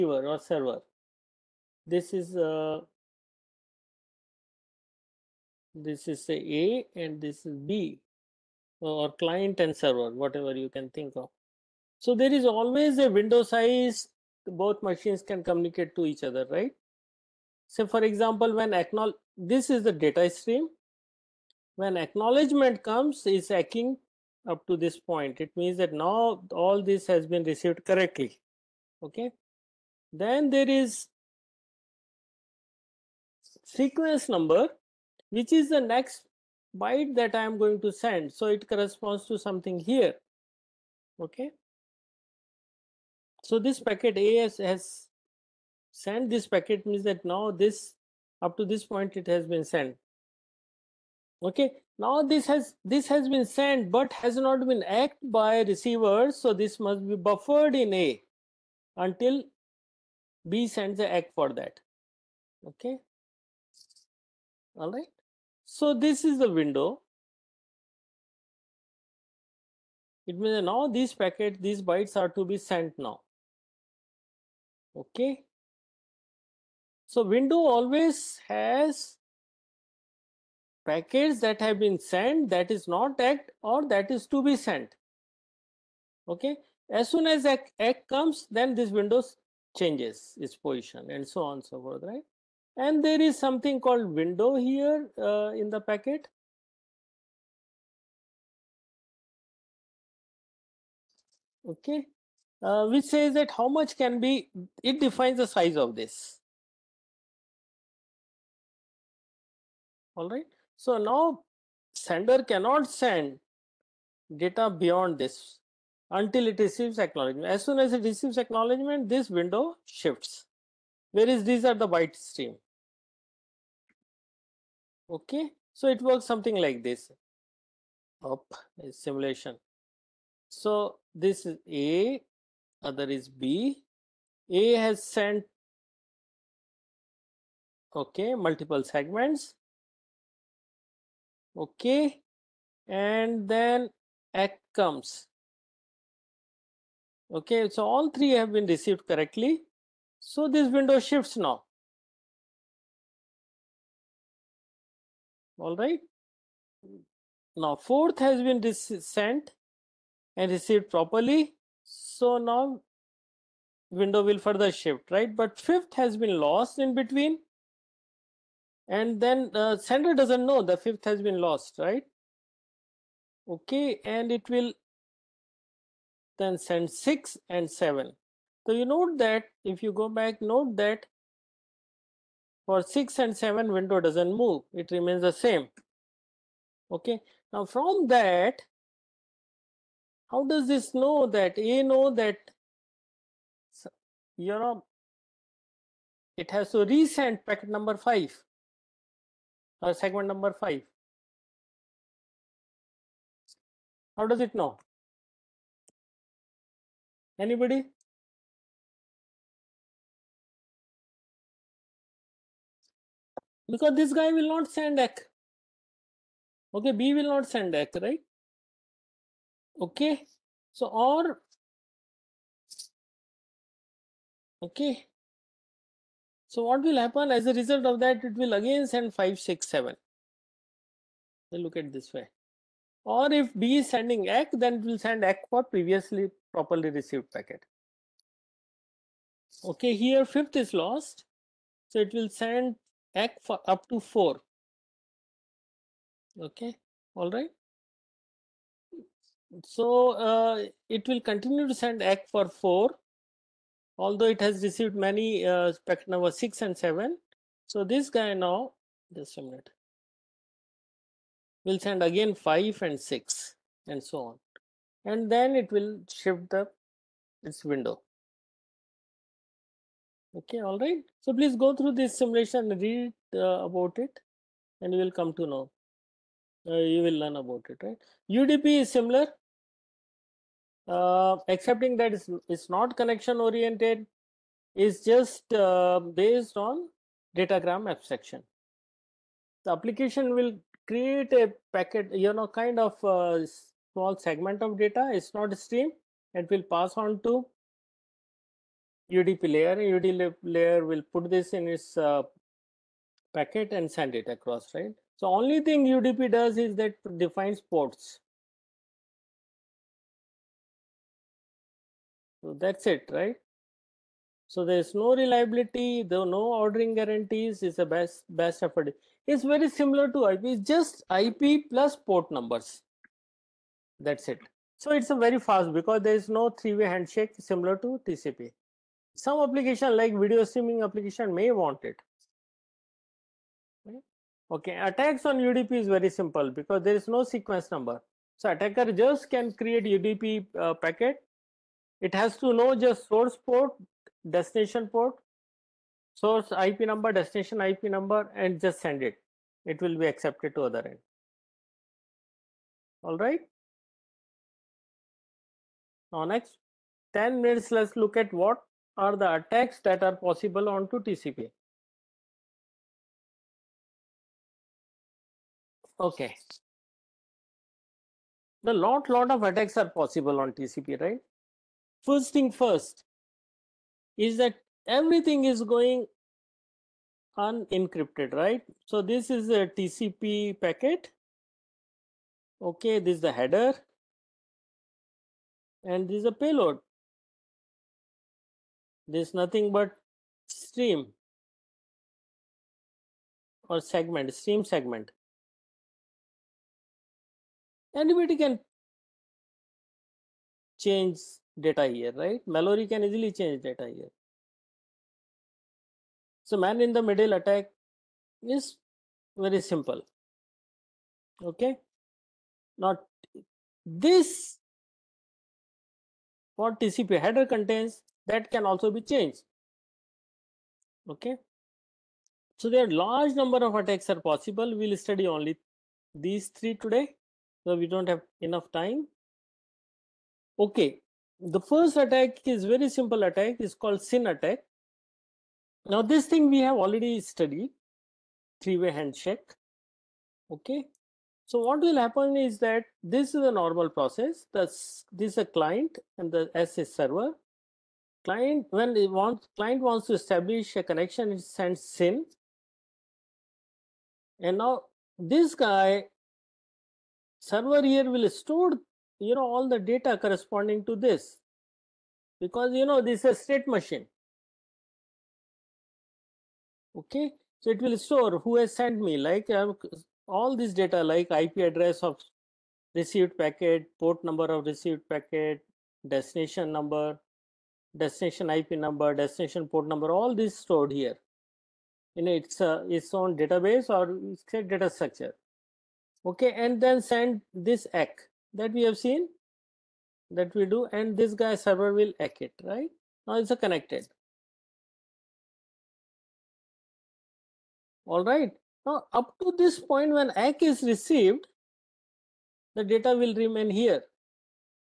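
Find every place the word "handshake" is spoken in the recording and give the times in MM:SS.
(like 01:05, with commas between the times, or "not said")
05:26, 07:18.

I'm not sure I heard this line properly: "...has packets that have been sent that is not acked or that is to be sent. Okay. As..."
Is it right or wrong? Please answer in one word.
right.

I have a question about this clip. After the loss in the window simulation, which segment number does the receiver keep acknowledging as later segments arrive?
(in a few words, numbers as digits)
4.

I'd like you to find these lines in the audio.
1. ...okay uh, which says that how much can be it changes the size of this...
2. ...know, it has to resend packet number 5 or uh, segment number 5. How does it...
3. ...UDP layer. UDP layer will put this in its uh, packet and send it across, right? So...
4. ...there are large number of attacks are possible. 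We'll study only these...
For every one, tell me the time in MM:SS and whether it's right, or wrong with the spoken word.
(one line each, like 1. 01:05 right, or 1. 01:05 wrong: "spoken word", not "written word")
1. 01:41 wrong: "defines", not "changes"
2. 03:14 right
3. 04:59 right
4. 07:02 right.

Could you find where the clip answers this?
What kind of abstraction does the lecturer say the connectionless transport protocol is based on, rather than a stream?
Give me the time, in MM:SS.
04:47.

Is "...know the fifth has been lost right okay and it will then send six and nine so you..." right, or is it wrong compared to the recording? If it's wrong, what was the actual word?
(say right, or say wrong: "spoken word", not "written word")
wrong: "seven", not "nine".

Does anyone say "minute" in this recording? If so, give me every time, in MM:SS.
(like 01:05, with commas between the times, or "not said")
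04:19, 05:57.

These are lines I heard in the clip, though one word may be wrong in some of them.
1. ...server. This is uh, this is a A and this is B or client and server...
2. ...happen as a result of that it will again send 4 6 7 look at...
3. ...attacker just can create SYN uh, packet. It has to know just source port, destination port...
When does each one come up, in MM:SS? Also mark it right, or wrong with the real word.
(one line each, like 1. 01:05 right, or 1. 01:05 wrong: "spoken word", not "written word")
1. 00:00 right
2. 03:47 wrong: "5", not "4"
3. 05:38 wrong: "UDP", not "SYN".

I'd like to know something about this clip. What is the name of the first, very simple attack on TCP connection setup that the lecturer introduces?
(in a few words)
SYN attack.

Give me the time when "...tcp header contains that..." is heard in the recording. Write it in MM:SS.
06:56.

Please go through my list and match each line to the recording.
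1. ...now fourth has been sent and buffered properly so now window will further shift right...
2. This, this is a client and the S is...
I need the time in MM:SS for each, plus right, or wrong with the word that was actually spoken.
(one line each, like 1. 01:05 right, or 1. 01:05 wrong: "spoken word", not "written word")
1. 02:37 wrong: "received", not "buffered"
2. 07:24 right.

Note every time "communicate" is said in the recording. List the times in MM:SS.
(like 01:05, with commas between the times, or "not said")
00:15.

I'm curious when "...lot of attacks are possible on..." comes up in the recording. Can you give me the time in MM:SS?
06:09.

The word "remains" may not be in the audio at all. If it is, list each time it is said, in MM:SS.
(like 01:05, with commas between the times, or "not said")
03:04, 08:23.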